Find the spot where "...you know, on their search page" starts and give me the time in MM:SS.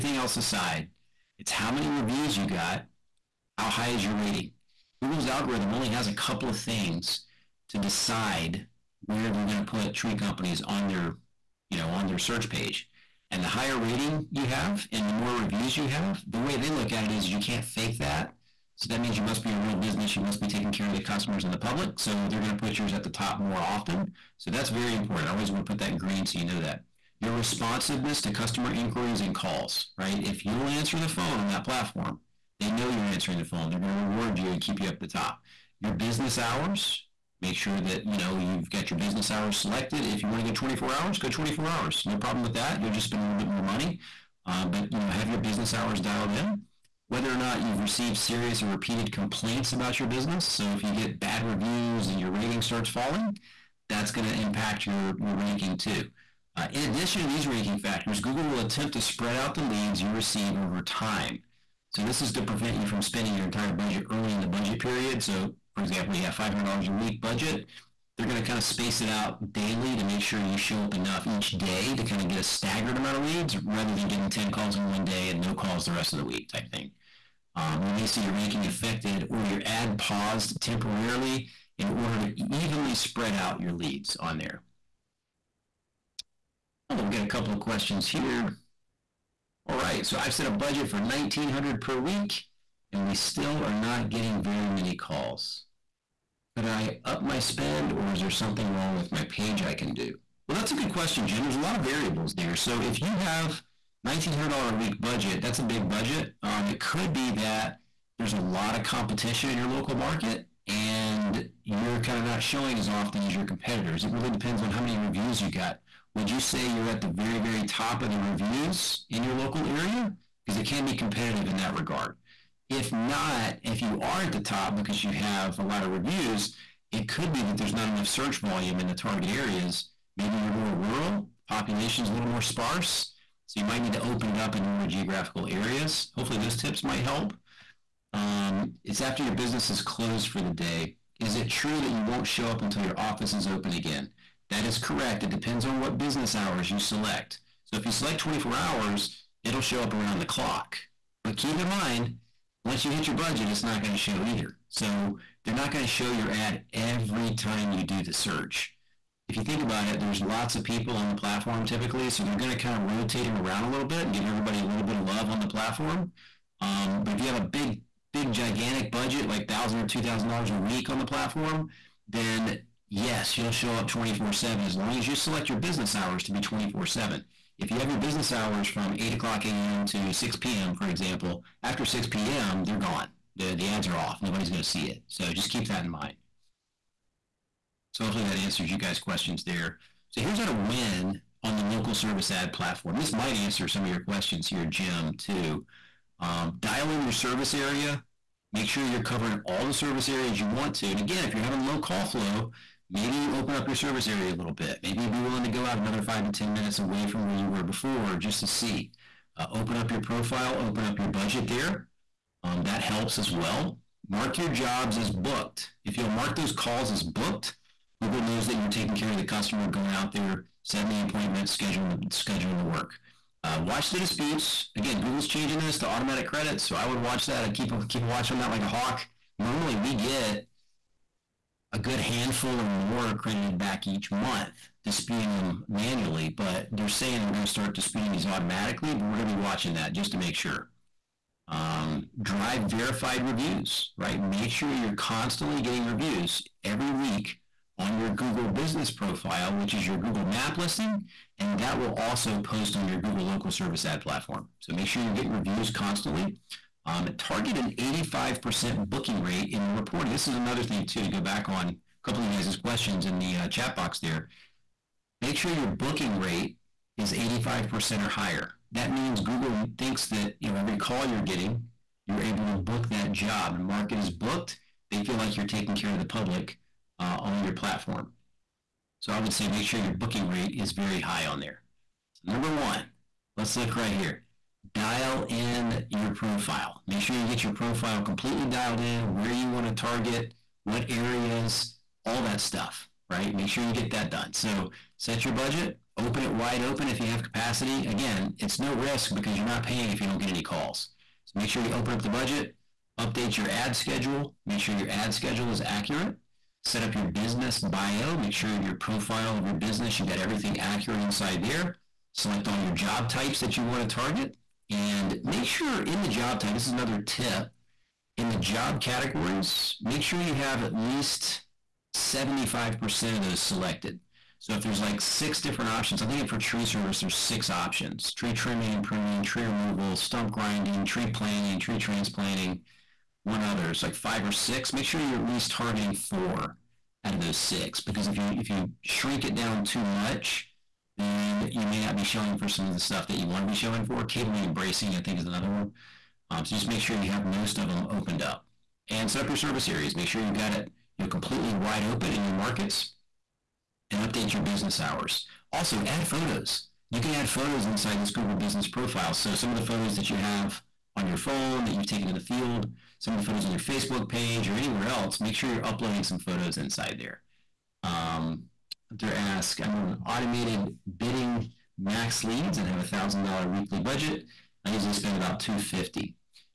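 00:11.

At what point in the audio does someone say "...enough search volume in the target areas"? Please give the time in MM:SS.
02:07.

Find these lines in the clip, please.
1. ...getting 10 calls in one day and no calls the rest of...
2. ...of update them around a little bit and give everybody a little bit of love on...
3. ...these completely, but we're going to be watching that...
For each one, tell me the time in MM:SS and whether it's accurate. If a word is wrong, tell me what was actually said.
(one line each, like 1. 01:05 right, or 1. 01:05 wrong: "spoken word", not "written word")
1. 01:14 right
2. 02:42 wrong: "rotate", not "update"
3. 03:58 wrong: "automatically", not "completely".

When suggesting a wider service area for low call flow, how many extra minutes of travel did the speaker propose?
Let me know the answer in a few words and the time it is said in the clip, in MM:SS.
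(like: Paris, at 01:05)
5 to 10 minutes, at 03:26.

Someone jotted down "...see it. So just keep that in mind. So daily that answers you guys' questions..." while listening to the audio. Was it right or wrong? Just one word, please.
wrong.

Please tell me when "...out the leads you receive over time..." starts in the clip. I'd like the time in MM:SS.
00:59.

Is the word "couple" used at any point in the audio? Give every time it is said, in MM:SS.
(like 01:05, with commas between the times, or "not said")
00:06, 01:27, 04:22.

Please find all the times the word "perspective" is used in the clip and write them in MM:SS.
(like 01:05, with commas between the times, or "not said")
not said.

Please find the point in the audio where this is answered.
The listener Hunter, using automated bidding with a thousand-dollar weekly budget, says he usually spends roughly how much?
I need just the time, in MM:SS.
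06:15.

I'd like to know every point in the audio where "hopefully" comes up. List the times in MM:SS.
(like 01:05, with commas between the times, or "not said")
02:16, 03:08.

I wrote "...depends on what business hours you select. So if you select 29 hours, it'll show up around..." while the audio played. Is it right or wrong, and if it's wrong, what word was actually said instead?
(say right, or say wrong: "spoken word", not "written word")
wrong: "24", not "29".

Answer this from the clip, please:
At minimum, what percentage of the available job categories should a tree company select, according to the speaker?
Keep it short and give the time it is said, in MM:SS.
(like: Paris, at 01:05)
75%, at 05:21.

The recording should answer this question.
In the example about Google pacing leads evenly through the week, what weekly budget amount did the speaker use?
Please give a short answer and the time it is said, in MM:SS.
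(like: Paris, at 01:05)
$500, at 01:06.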